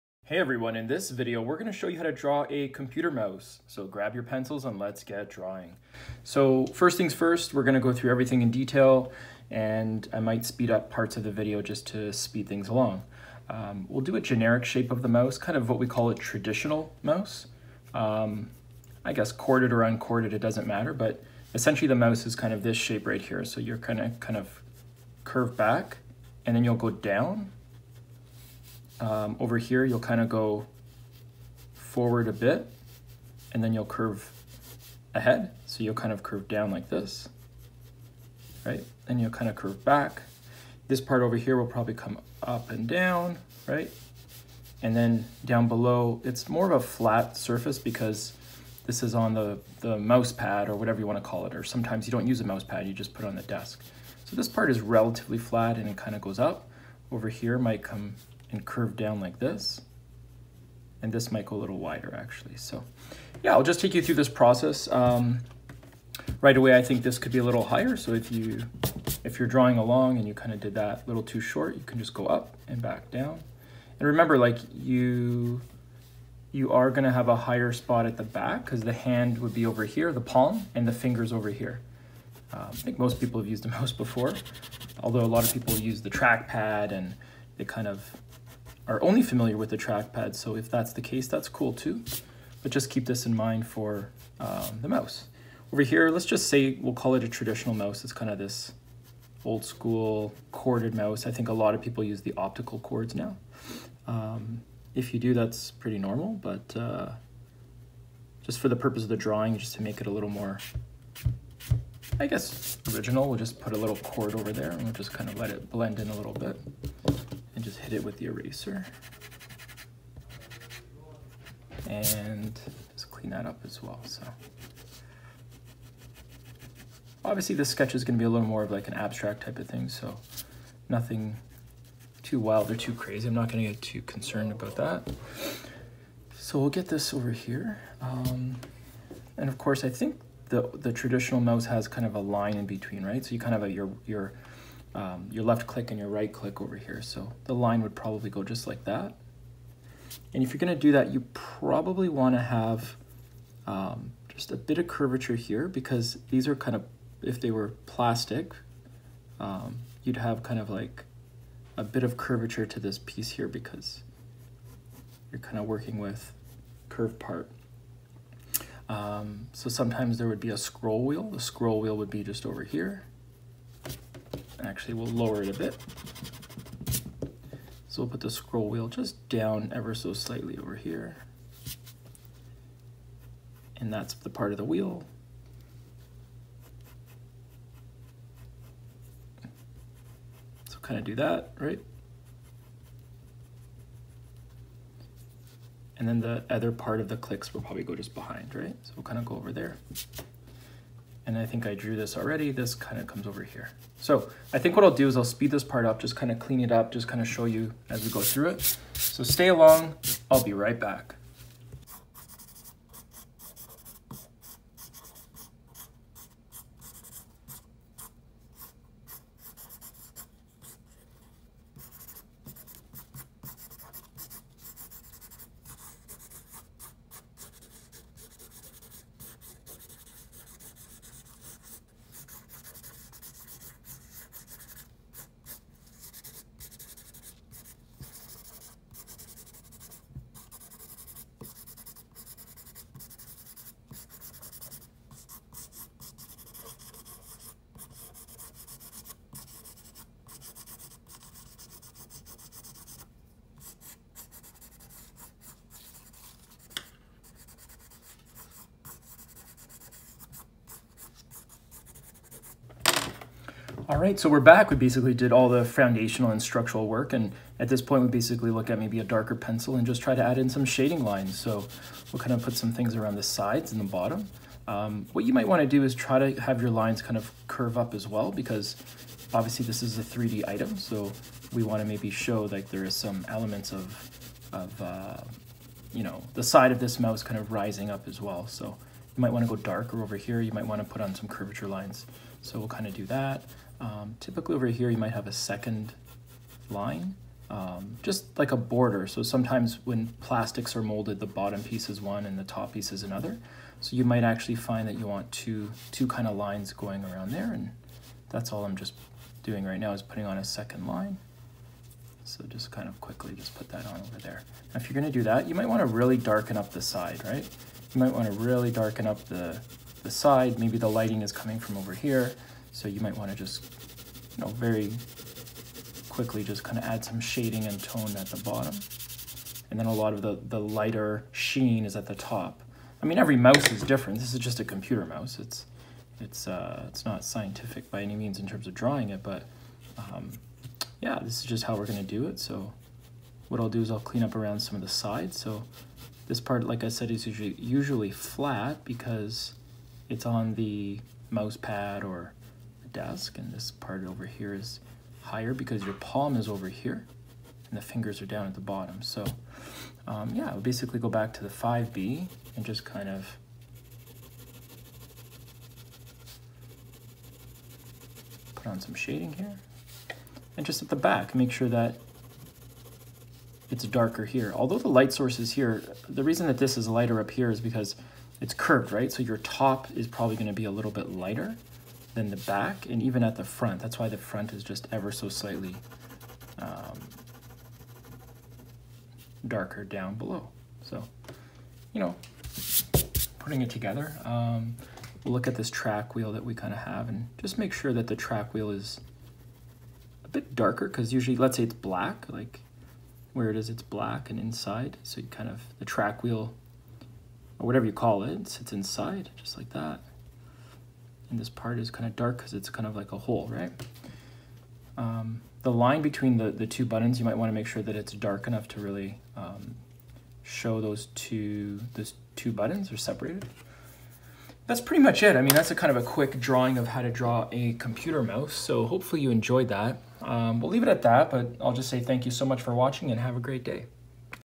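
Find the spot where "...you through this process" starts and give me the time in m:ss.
1:03.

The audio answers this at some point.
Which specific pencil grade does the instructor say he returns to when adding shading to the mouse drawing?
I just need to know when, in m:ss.
6:01.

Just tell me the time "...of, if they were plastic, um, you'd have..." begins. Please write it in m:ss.
2:36.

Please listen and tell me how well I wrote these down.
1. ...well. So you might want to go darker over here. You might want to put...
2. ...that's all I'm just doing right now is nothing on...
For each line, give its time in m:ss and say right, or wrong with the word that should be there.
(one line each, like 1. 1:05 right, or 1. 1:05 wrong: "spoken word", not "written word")
1. 4:48 right
2. 5:08 wrong: "putting", not "nothing".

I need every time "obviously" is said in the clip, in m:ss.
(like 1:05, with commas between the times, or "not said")
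2:07, 4:39.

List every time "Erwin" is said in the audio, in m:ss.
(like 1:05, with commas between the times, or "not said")
not said.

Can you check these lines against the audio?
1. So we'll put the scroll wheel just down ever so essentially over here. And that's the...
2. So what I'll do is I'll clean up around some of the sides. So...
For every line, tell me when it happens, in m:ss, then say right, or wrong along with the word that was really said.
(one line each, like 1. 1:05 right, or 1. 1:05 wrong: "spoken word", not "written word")
1. 2:57 wrong: "slightly", not "essentially"
2. 5:42 right.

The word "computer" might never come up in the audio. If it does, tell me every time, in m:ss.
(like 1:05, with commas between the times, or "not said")
0:02, 5:34, 7:07.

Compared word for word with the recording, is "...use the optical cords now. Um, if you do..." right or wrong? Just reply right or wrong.
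right.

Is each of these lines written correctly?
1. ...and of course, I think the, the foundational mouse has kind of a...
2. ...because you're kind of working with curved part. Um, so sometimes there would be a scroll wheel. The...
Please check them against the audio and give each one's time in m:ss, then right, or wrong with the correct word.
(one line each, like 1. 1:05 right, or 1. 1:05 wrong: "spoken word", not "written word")
1. 2:19 wrong: "traditional", not "foundational"
2. 2:43 right.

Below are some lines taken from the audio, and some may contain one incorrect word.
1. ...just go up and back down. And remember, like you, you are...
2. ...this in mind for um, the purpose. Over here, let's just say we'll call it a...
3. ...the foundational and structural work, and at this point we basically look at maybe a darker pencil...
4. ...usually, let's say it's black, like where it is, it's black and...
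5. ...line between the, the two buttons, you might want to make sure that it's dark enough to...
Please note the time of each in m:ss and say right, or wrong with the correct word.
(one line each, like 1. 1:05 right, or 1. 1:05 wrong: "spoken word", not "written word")
1. 1:11 right
2. 1:33 wrong: "mouse", not "purpose"
3. 4:25 right
4. 6:41 right
5. 6:55 right.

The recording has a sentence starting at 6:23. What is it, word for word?
That's why the front is just ever so slightly um, darker down below.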